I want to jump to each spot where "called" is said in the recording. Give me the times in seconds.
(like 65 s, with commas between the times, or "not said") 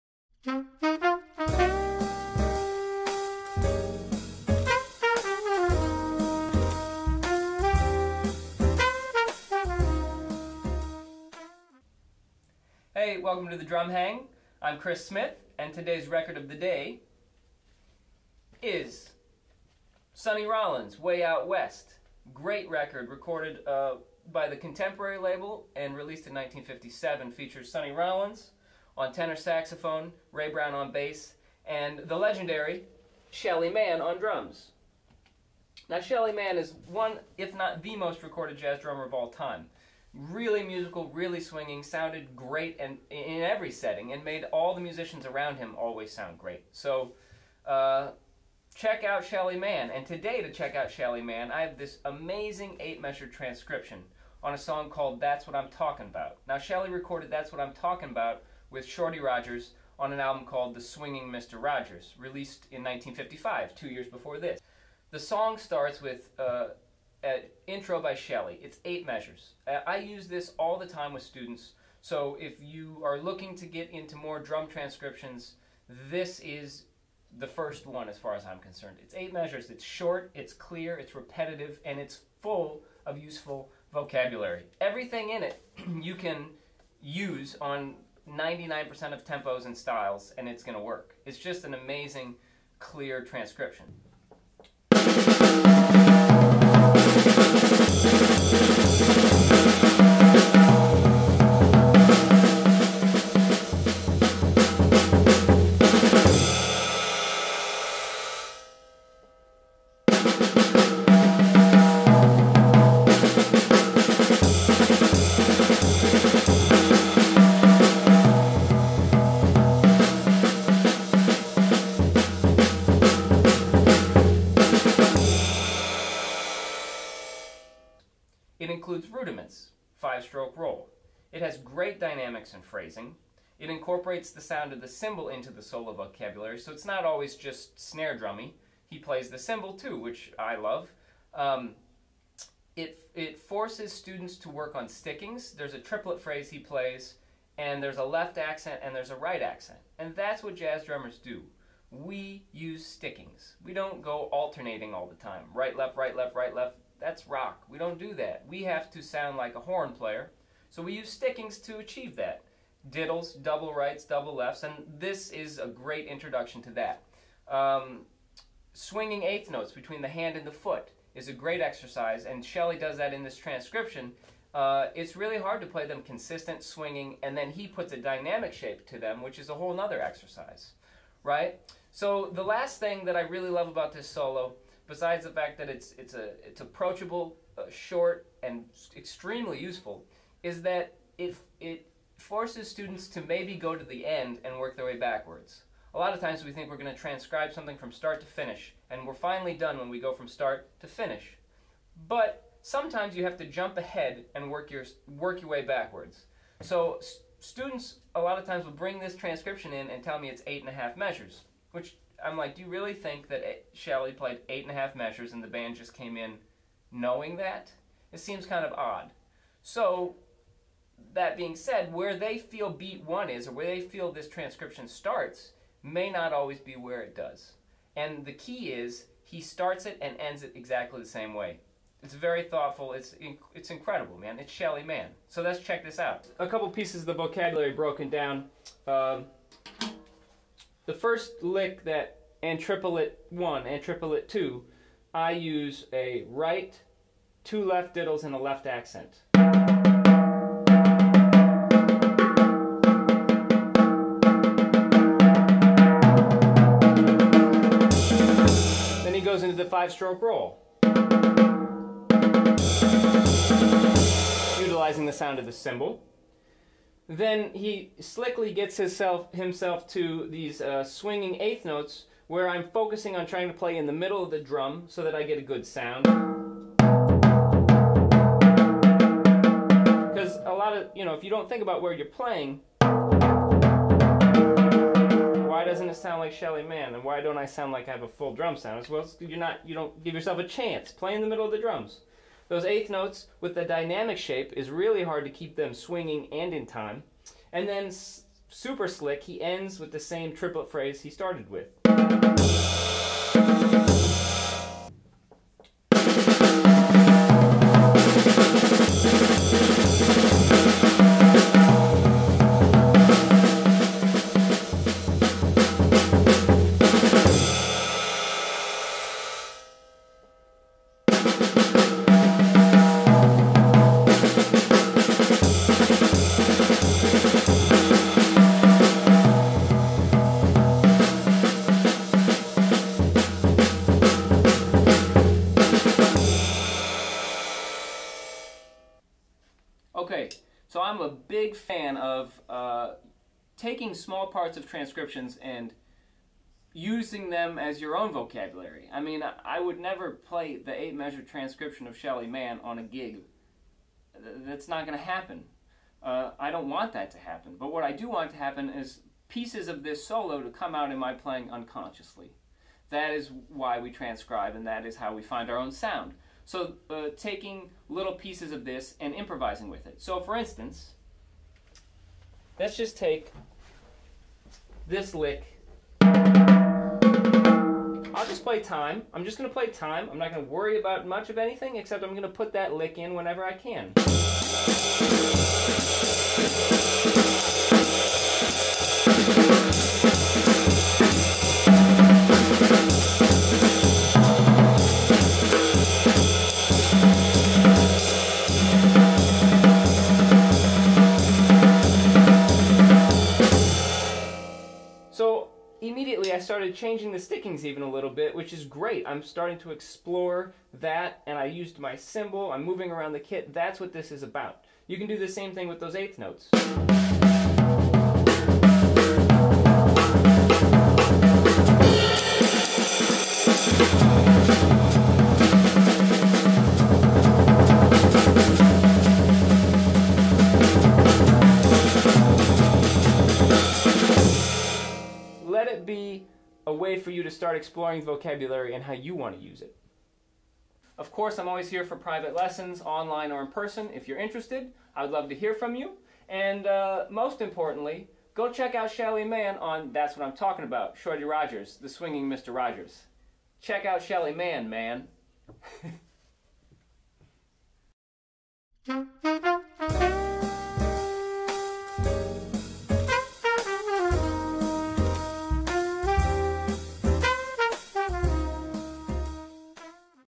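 54 s, 60 s.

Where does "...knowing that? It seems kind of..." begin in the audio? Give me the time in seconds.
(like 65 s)
216 s.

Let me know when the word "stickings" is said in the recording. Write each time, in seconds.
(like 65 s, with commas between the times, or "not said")
144 s, 152 s, 161 s, 407 s.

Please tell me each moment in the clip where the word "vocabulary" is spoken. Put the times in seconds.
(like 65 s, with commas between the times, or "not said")
83 s, 135 s, 237 s, 348 s, 438 s.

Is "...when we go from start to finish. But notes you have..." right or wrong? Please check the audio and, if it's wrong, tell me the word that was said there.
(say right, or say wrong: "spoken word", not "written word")
wrong: "sometimes", not "notes".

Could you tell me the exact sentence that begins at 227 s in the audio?
And the key is he starts it and ends it exactly the same way.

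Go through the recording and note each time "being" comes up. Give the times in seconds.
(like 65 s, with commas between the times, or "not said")
221 s.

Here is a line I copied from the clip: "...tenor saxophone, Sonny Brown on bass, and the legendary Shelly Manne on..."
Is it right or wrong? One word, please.
wrong.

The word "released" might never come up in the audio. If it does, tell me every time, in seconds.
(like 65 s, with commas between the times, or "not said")
25 s, 62 s.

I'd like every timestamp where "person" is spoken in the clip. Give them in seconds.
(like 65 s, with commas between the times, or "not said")
443 s.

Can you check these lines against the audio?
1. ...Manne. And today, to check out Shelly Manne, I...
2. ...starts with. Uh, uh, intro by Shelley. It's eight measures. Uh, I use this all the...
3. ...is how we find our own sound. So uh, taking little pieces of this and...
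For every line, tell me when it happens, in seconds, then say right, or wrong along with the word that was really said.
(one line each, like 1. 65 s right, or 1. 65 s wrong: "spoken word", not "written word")
1. 49 s right
2. 65 s right
3. 364 s right.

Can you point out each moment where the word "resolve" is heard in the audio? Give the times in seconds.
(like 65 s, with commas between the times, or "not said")
not said.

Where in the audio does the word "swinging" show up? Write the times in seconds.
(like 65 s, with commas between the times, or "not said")
41 s, 60 s, 168 s, 176 s, 270 s, 295 s, 451 s.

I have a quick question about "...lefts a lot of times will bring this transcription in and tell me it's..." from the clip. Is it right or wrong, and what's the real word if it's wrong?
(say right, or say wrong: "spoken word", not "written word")
wrong: "students", not "lefts".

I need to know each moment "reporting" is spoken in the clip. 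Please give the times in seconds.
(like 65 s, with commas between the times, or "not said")
not said.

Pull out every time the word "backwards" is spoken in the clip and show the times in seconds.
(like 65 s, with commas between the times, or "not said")
194 s, 205 s.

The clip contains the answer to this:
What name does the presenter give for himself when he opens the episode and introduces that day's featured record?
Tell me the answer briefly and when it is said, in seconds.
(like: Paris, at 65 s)
Chris Smith, at 14 s.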